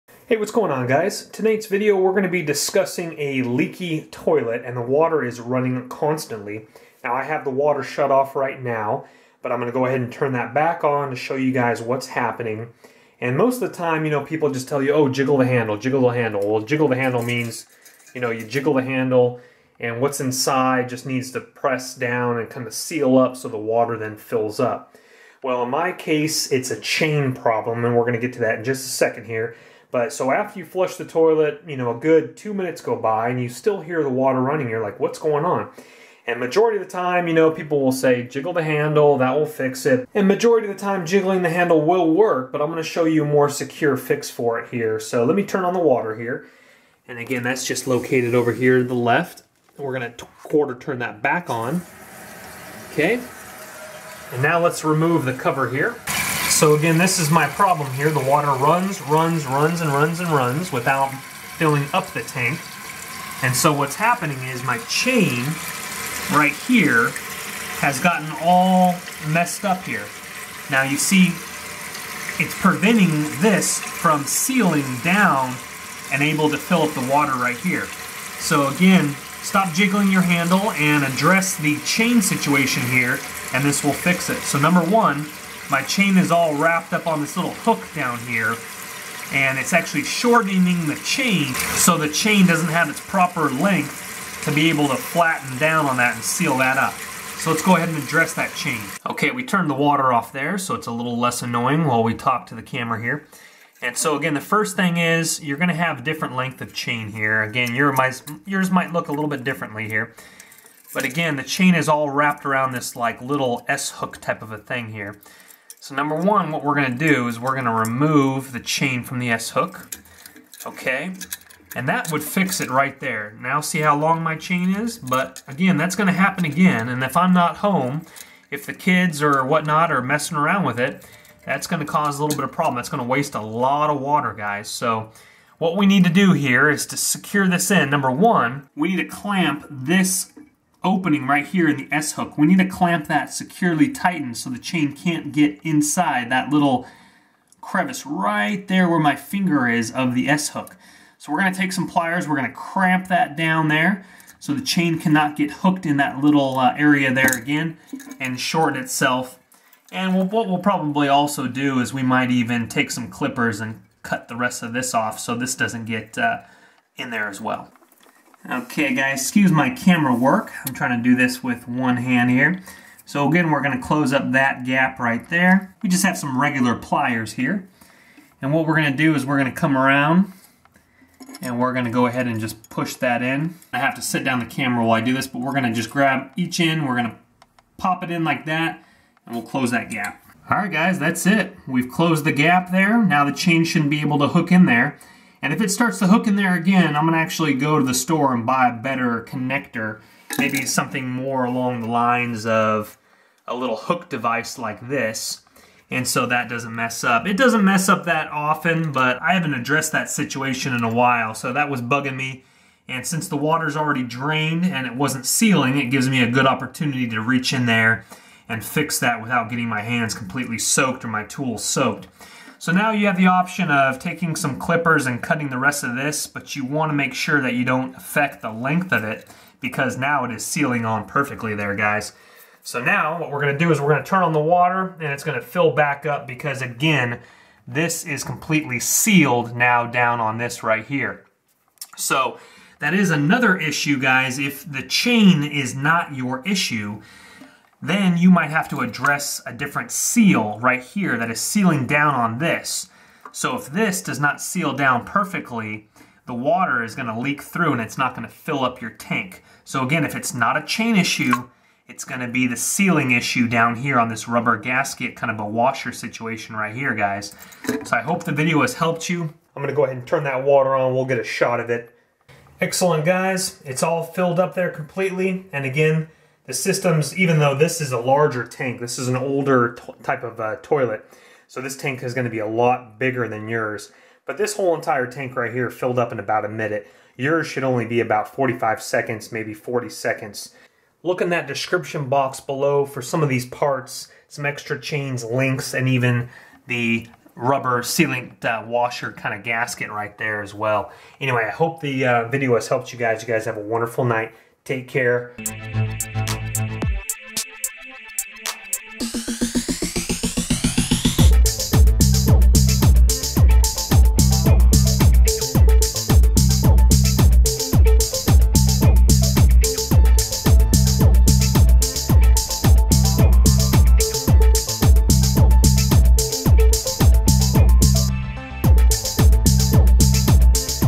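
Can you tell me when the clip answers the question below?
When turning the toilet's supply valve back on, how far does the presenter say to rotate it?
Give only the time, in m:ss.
0:50.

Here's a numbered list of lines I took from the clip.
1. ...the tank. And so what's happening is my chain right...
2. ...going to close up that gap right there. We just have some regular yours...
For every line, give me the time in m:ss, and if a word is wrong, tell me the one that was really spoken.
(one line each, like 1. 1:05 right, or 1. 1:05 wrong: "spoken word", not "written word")
1. 1:02 right
2. 2:53 wrong: "pliers", not "yours".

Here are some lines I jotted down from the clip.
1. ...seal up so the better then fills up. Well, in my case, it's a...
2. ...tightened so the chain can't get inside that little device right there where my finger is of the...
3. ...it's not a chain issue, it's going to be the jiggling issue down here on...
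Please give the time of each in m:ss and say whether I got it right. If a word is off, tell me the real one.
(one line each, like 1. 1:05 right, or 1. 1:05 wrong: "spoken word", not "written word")
1. 0:22 wrong: "water", not "better"
2. 2:23 wrong: "crevice", not "device"
3. 4:20 wrong: "sealing", not "jiggling".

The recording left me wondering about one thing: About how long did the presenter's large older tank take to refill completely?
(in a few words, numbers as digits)
about a minute.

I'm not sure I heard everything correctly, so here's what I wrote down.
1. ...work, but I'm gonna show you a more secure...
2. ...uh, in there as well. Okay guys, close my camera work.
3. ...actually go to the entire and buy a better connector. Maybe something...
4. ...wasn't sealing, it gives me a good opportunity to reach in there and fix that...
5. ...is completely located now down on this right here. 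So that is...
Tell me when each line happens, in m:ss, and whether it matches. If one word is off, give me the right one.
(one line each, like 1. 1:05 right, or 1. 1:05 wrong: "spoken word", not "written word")
1. 0:42 right
2. 2:46 wrong: "excuse", not "close"
3. 3:17 wrong: "store", not "entire"
4. 3:34 right
5. 3:58 wrong: "sealed", not "located".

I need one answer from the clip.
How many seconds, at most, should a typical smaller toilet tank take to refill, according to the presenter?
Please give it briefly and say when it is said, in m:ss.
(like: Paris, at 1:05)
45 seconds, at 4:48.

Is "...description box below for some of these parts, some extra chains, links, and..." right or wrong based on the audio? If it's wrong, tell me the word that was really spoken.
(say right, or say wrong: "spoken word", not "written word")
right.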